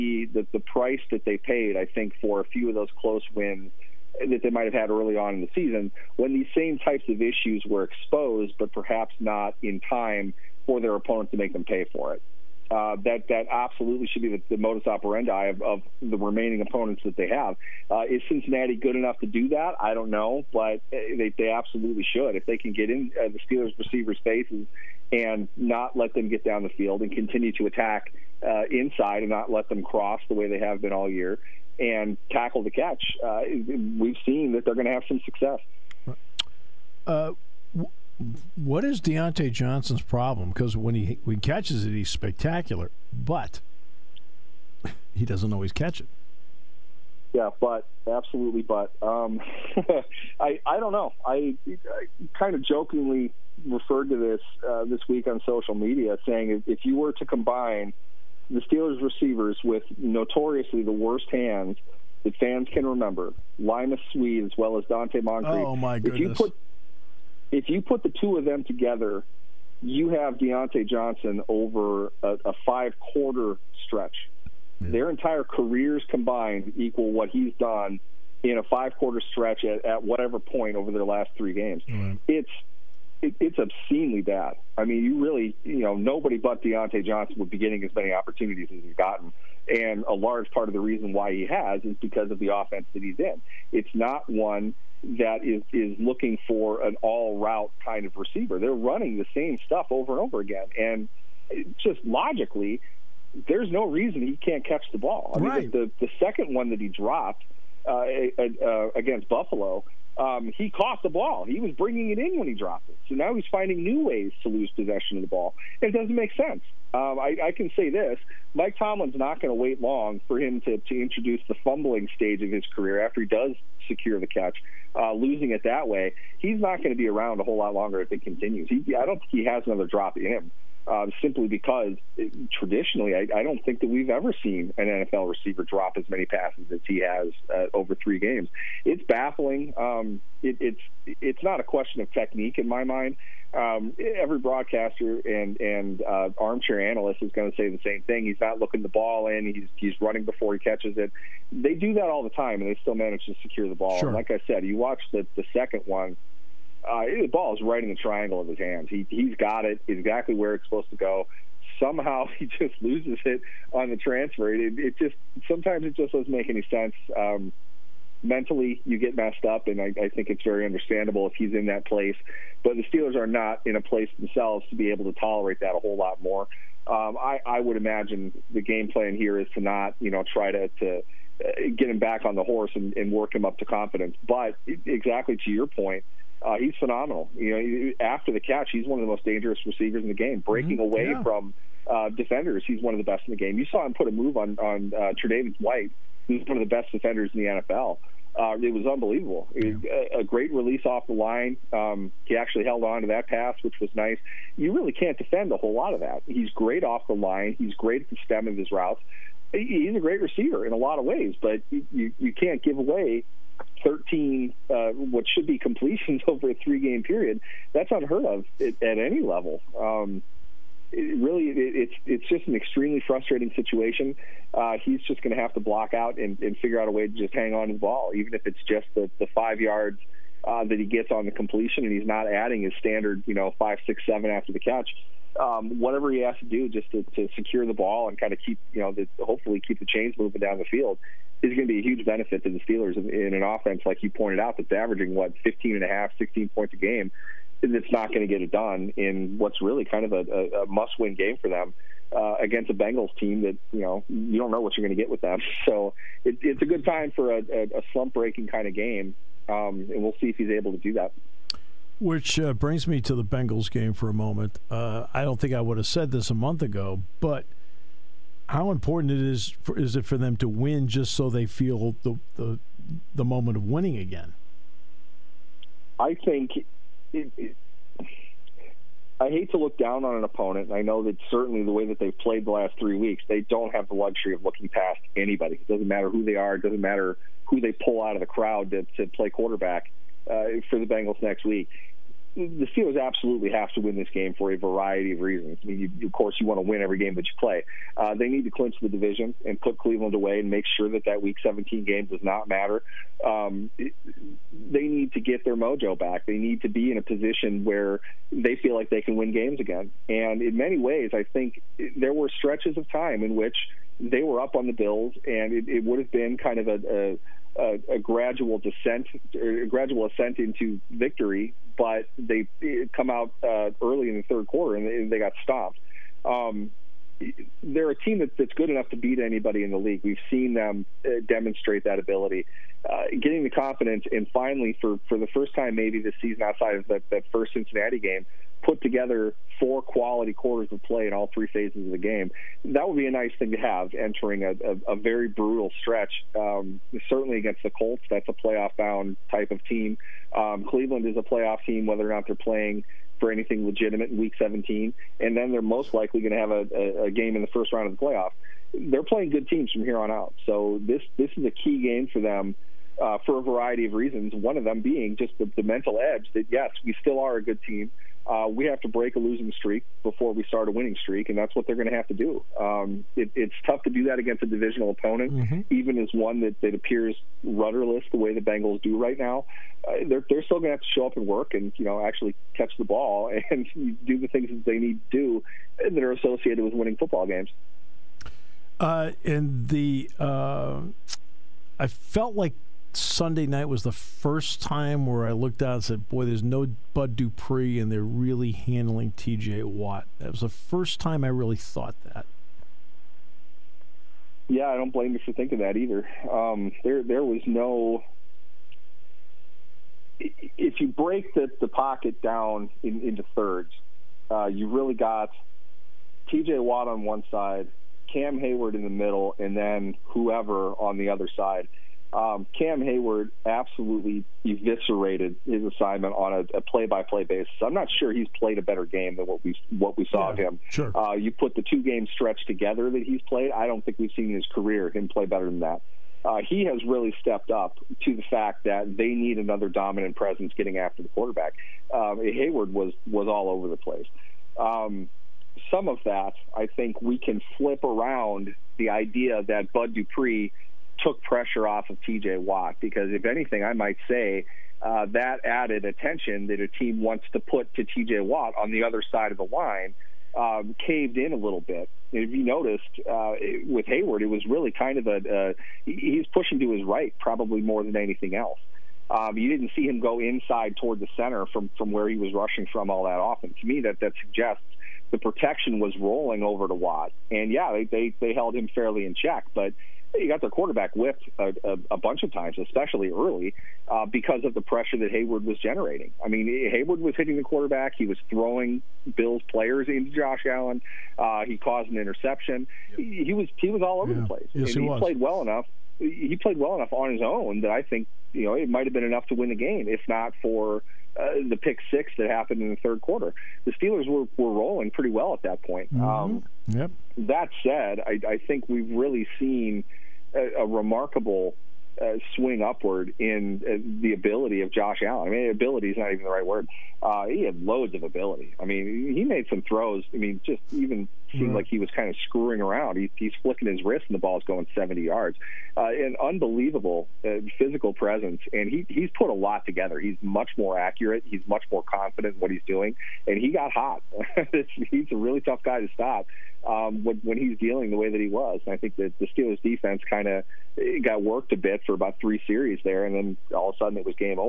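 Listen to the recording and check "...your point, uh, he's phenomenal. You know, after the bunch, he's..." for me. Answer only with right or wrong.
wrong.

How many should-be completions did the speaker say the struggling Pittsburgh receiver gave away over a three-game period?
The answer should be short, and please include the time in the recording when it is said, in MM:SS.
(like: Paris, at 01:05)
13, at 03:33.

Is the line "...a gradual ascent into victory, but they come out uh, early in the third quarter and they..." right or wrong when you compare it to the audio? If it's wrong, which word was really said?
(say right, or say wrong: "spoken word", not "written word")
right.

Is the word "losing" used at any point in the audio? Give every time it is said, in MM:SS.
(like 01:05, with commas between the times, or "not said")
02:05, 06:09.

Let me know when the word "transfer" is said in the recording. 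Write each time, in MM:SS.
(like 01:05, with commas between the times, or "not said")
02:43.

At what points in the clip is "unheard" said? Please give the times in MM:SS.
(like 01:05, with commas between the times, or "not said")
03:37.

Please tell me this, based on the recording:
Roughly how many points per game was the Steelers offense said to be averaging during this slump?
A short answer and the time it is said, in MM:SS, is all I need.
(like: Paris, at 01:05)
15 and a half, at 04:05.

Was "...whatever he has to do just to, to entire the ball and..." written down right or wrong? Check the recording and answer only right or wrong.
wrong.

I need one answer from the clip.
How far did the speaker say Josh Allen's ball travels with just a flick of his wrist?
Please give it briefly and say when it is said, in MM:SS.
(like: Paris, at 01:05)
70 yards, at 08:44.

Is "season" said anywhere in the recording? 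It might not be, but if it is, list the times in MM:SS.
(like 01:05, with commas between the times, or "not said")
00:05, 05:36.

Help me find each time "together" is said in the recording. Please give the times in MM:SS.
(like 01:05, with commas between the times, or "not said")
01:08, 05:38, 07:12, 08:49.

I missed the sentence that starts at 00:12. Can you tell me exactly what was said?
Uh, that that absolutely should be the, the modus operandi of, of, the remaining opponents that they have.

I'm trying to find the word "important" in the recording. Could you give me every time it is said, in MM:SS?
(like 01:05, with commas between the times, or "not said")
04:28.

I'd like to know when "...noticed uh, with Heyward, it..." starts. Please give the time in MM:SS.
07:42.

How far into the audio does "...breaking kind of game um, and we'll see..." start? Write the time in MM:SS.
04:18.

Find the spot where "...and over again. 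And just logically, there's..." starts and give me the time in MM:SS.
01:40.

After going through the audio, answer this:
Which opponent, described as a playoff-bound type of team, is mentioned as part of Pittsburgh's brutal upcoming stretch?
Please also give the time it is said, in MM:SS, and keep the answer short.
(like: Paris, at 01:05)
Colts, at 05:47.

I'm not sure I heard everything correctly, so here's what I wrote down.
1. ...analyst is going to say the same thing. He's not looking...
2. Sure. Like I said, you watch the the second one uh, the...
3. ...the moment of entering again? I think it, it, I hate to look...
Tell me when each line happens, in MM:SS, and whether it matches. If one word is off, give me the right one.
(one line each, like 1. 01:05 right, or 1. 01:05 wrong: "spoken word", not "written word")
1. 02:26 right
2. 02:33 right
3. 04:33 wrong: "winning", not "entering".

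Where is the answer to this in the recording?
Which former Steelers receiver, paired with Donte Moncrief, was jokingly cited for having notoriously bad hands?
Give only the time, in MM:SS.
01:03.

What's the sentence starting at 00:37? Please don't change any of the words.
Uh, what is Diontae Johnson's problem?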